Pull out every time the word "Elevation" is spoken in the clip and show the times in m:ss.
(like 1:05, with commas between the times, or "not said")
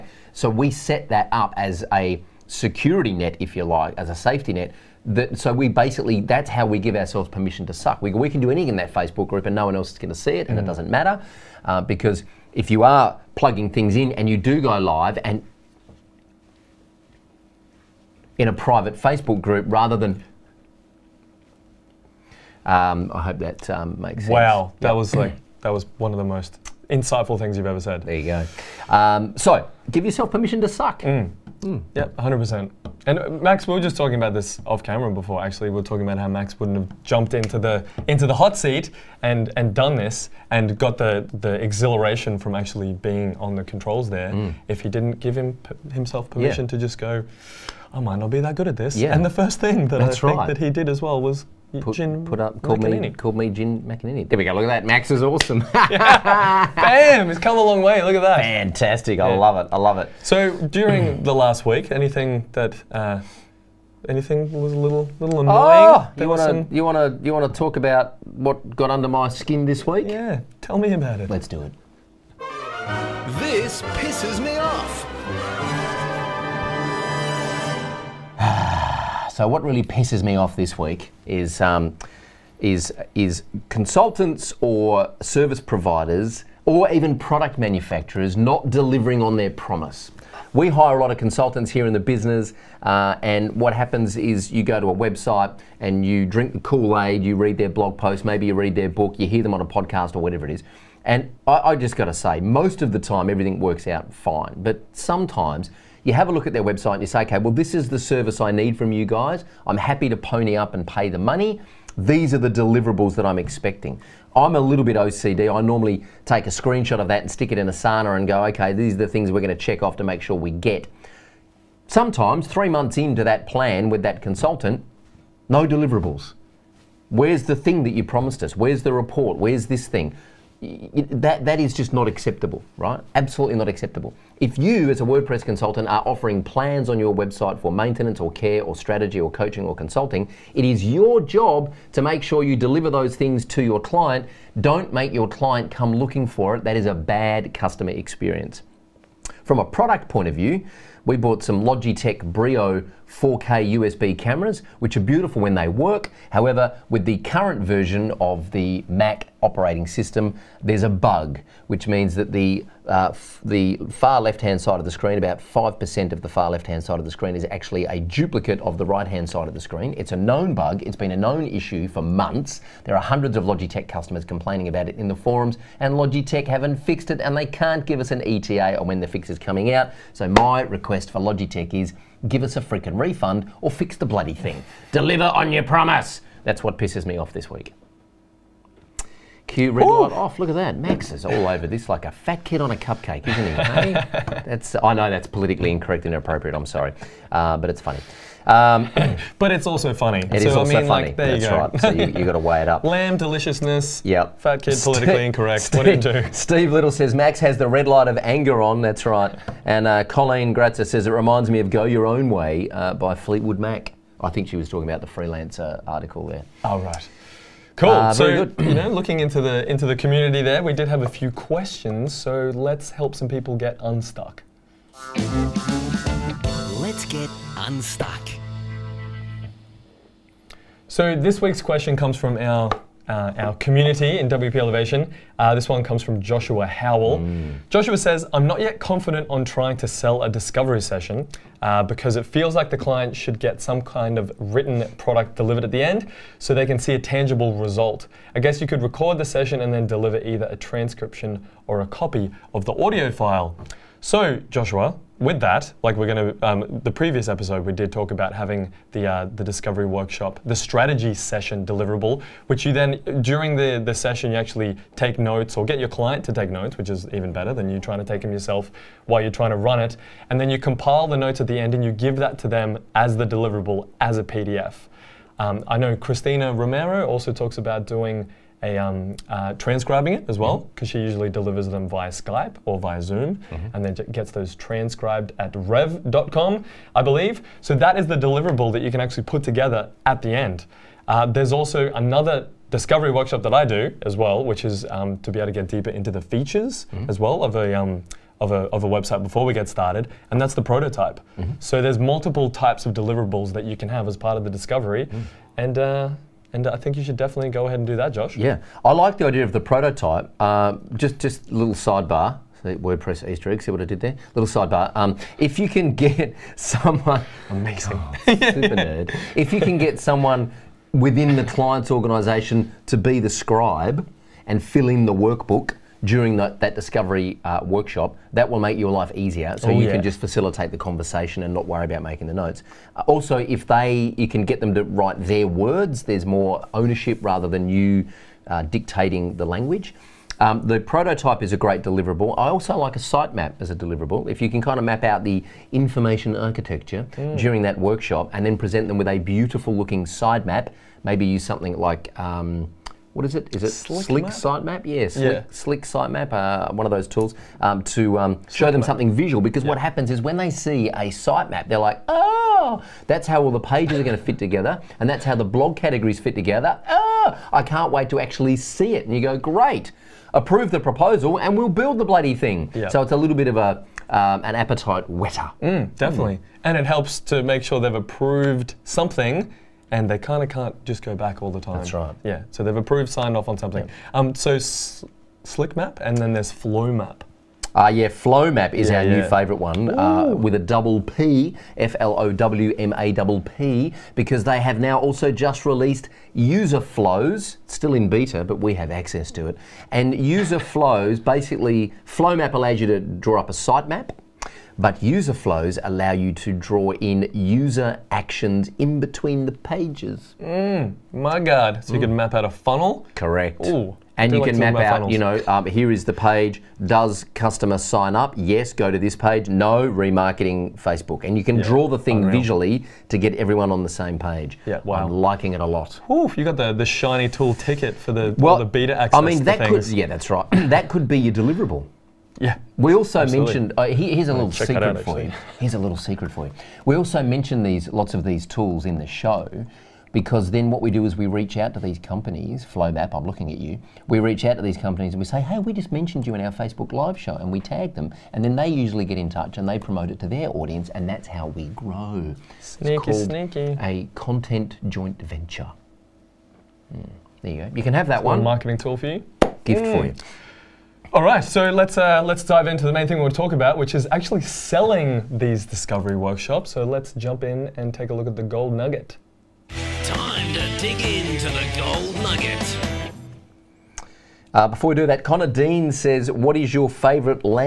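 3:54.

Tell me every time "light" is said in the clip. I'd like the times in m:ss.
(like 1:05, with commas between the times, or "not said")
3:10, 3:27.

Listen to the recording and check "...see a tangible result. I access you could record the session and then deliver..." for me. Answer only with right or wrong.
wrong.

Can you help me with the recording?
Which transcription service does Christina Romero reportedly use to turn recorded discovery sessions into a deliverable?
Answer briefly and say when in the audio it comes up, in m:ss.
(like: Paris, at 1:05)
rev.com, at 4:45.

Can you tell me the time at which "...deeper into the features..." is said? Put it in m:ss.
4:55.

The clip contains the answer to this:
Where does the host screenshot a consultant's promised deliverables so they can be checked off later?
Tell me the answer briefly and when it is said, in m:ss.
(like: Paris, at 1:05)
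Asana, at 1:57.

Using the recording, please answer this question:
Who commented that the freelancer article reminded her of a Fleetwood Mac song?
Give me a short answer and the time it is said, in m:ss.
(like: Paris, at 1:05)
Colleen Gratzer, at 3:30.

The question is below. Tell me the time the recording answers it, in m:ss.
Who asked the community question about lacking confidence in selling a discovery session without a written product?
3:56.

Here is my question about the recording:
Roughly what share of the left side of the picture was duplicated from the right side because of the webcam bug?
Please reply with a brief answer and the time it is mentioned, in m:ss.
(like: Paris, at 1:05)
5%, at 2:45.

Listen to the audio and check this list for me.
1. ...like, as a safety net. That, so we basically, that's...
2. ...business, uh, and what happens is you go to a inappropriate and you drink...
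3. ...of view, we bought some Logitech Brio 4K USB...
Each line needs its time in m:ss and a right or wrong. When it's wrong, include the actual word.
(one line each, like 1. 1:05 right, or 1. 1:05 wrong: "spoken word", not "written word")
1. 0:03 right
2. 1:31 wrong: "website", not "inappropriate"
3. 2:30 right.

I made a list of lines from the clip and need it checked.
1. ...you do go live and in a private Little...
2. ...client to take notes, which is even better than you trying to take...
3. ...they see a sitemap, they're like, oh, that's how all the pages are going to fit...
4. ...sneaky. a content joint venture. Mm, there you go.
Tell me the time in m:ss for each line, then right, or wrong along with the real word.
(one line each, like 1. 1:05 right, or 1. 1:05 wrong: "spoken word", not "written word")
1. 0:14 wrong: "Facebook", not "Little"
2. 4:25 right
3. 6:00 right
4. 7:33 right.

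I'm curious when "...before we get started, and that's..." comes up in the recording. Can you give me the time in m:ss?
4:59.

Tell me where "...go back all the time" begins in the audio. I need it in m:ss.
6:21.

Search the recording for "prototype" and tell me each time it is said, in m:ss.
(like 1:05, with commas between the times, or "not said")
5:00, 5:09, 5:40.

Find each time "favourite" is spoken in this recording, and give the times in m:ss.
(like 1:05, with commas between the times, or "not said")
6:29, 7:56.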